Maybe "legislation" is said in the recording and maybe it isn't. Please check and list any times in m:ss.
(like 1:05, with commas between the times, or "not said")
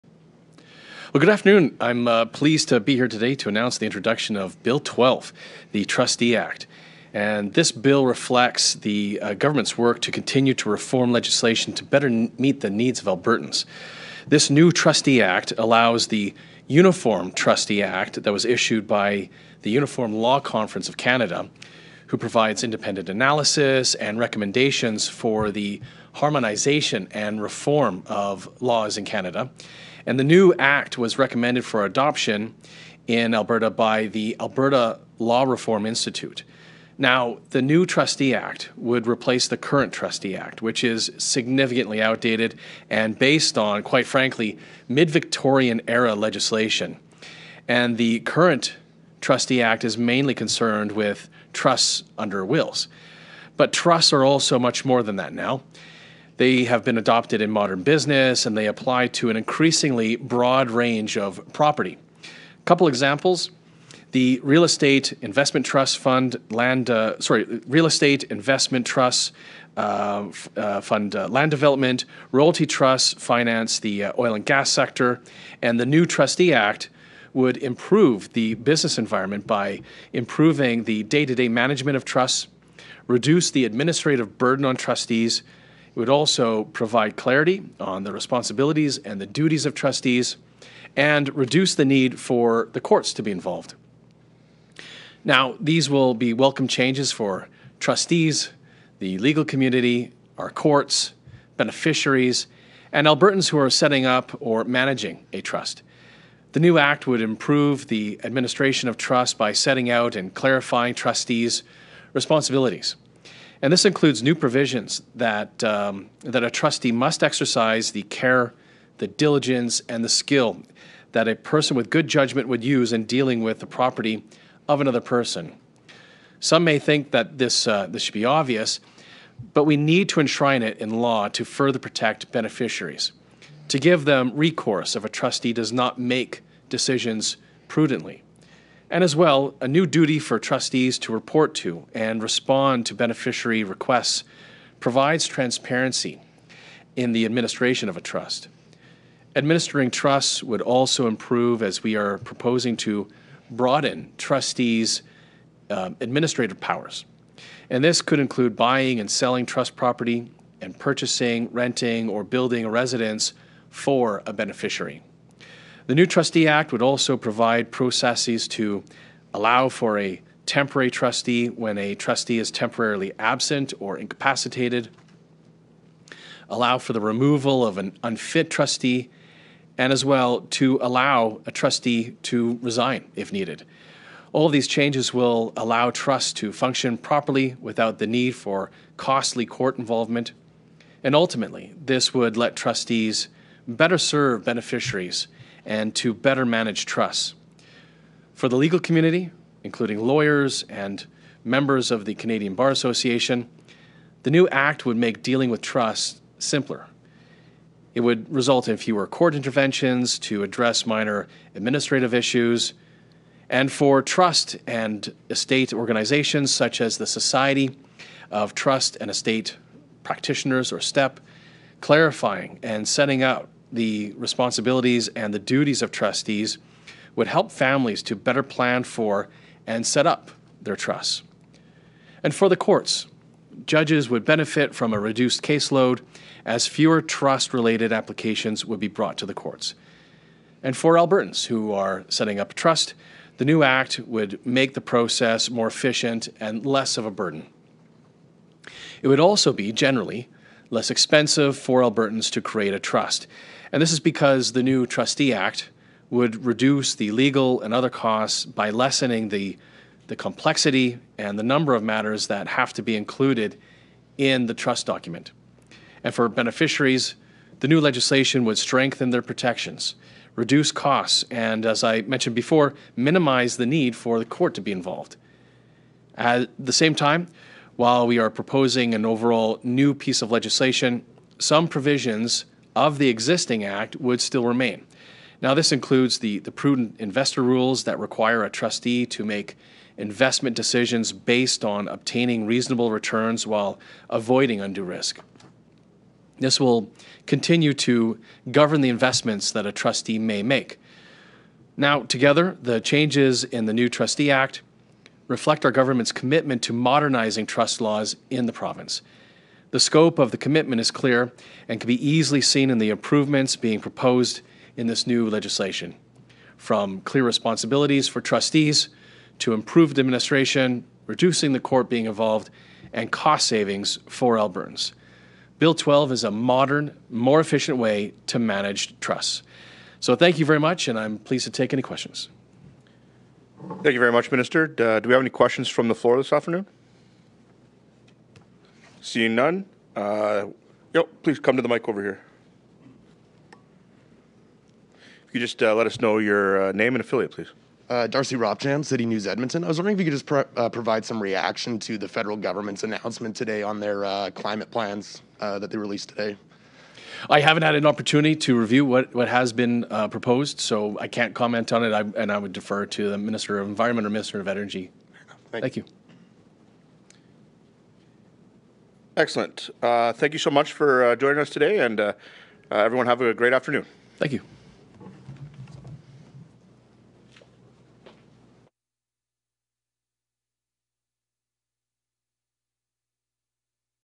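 0:11, 0:46, 4:27, 4:40, 5:15.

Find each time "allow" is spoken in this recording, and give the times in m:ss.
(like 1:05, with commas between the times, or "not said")
0:15, 2:49, 2:56, 3:00, 3:05.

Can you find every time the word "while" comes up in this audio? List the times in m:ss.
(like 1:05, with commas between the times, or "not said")
4:37, 4:53.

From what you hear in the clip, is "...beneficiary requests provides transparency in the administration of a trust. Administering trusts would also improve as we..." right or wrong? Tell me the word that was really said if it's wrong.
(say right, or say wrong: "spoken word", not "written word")
right.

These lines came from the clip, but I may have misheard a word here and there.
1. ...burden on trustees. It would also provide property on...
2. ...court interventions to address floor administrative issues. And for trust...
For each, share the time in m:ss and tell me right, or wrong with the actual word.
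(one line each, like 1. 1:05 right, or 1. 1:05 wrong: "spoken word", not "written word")
1. 1:24 wrong: "clarity", not "property"
2. 3:29 wrong: "minor", not "floor".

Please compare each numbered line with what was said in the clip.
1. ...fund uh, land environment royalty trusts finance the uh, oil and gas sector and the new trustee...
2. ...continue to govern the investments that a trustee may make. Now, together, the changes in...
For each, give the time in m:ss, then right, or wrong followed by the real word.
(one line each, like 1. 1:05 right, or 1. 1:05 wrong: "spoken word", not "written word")
1. 1:10 wrong: "development", not "environment"
2. 4:57 right.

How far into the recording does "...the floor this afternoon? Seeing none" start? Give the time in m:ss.
5:35.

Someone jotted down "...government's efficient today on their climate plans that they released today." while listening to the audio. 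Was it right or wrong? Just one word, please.
wrong.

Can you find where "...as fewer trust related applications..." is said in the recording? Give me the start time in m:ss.
3:56.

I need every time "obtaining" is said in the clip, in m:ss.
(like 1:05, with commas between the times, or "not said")
4:51.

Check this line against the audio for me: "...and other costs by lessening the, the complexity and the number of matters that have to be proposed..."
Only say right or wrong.
wrong.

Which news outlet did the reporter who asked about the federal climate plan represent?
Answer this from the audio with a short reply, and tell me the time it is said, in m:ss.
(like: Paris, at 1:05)
City News Edmonton, at 5:48.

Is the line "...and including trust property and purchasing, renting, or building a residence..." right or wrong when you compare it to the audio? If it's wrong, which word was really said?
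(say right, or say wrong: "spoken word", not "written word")
wrong: "selling", not "including".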